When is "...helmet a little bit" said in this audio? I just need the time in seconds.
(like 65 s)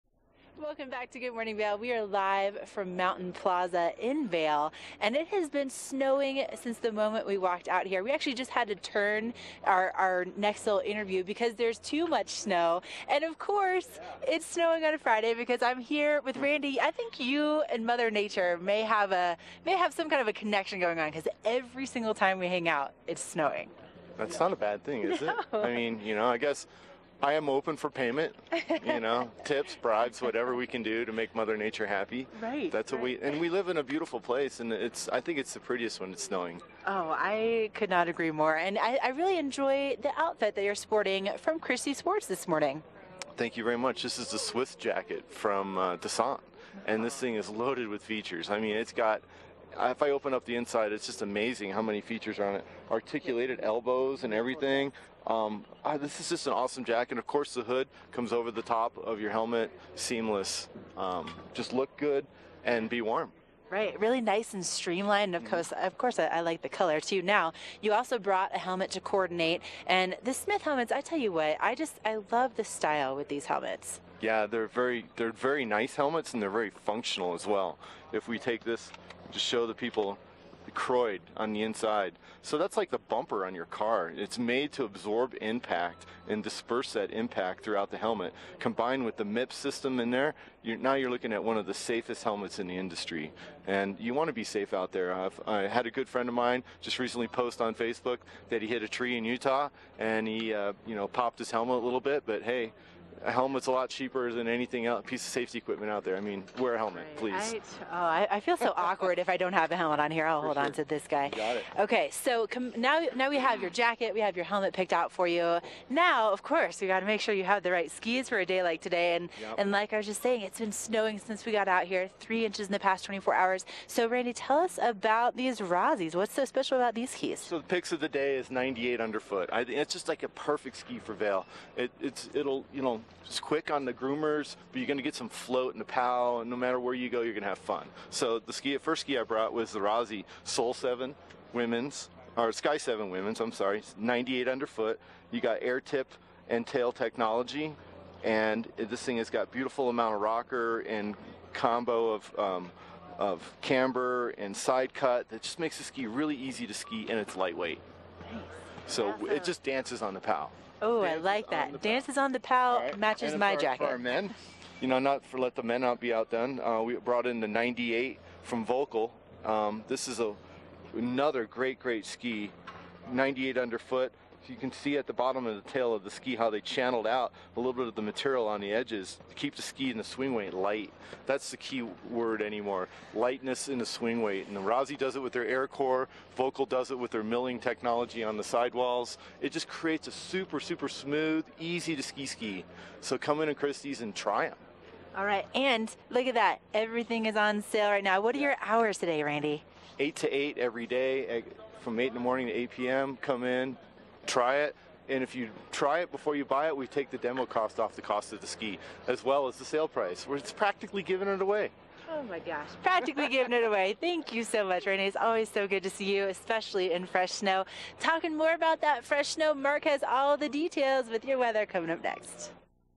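101 s.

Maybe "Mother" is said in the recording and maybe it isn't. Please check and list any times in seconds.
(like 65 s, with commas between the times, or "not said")
17 s, 31 s.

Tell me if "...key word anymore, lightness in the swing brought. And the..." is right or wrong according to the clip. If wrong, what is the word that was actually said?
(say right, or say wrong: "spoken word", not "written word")
wrong: "weight", not "brought".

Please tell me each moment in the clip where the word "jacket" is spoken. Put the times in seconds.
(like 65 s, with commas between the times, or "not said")
44 s, 56 s, 113 s, 163 s.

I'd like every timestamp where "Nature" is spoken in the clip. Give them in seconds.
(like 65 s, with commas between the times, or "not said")
18 s, 31 s.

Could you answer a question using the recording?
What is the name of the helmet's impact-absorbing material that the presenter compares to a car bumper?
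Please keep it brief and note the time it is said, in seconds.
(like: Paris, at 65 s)
Koroyd, at 80 s.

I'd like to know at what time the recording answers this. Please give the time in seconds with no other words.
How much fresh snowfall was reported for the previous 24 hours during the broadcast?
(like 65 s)
122 s.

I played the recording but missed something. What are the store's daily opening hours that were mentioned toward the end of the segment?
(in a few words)
8 to 8.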